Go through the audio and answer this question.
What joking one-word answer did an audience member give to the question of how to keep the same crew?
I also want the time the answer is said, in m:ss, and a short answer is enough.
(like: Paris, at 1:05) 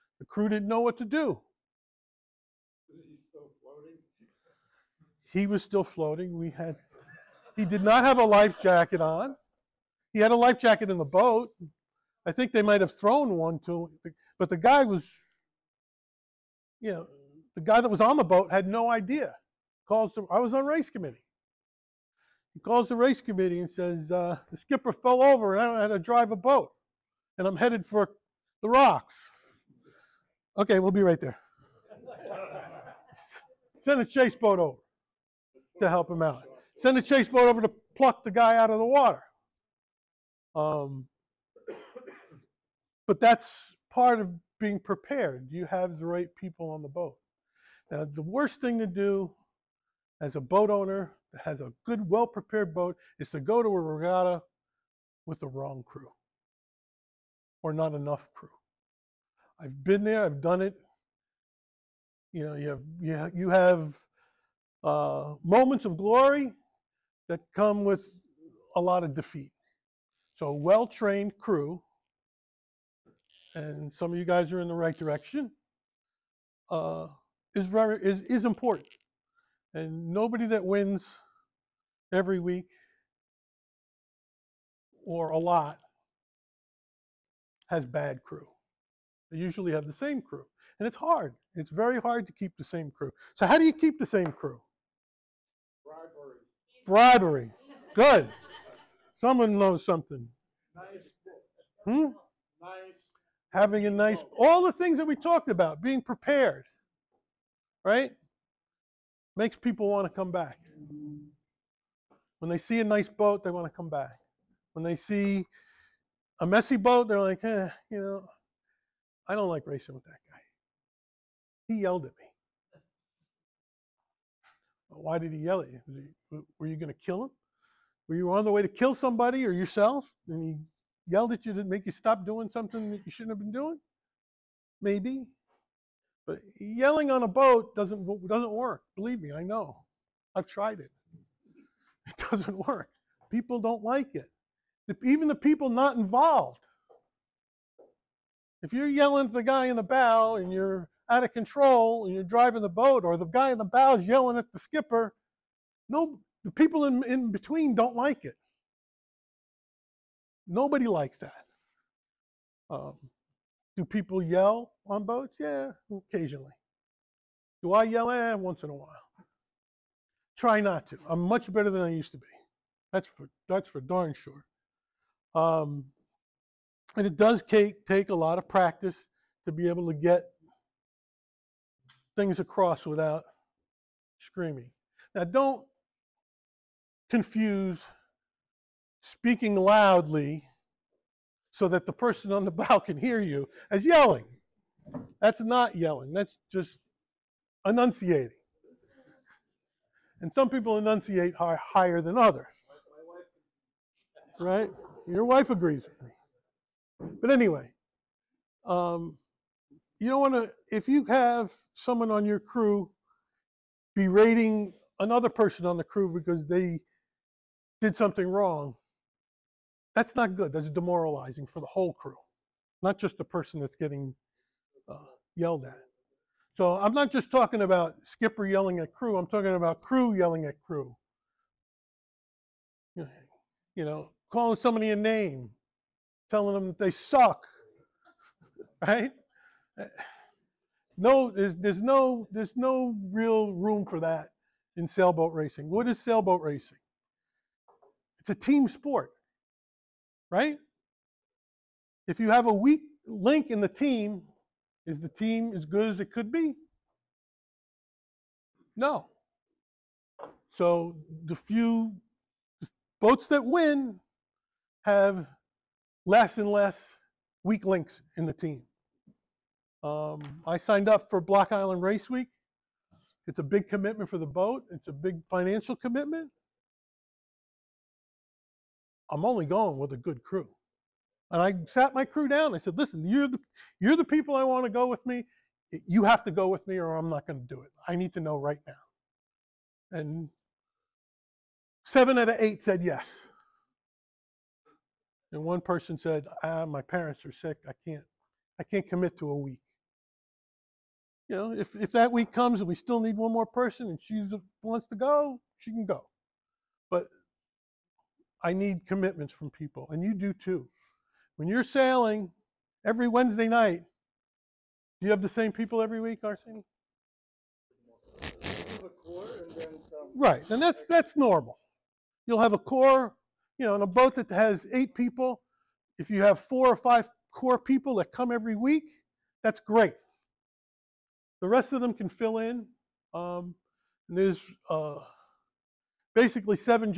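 Bribery, at 1:36.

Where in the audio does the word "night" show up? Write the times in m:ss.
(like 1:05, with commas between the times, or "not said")
5:13.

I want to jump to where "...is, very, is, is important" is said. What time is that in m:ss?
1:17.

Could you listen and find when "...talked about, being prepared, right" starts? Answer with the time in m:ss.
1:45.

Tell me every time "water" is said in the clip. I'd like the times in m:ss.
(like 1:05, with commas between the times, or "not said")
0:38.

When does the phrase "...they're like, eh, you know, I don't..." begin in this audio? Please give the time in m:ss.
1:57.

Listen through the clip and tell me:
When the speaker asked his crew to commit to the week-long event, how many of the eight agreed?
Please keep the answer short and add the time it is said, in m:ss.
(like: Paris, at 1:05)
7, at 4:51.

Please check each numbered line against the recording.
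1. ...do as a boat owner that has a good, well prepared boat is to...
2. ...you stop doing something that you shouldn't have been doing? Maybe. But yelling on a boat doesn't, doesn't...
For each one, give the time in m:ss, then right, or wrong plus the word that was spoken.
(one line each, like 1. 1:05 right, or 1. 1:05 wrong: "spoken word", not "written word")
1. 0:48 right
2. 2:11 right.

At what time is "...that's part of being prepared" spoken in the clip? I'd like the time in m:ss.
0:43.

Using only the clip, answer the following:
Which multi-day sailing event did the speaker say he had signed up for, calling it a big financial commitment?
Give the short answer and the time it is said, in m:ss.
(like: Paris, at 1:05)
Block Island Race Week, at 4:31.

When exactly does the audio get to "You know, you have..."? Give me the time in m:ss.
1:02.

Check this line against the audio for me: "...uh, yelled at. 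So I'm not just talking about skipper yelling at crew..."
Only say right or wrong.
right.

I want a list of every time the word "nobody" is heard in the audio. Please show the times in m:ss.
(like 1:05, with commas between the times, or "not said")
1:20, 2:40.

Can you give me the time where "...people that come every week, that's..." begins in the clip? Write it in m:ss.
5:27.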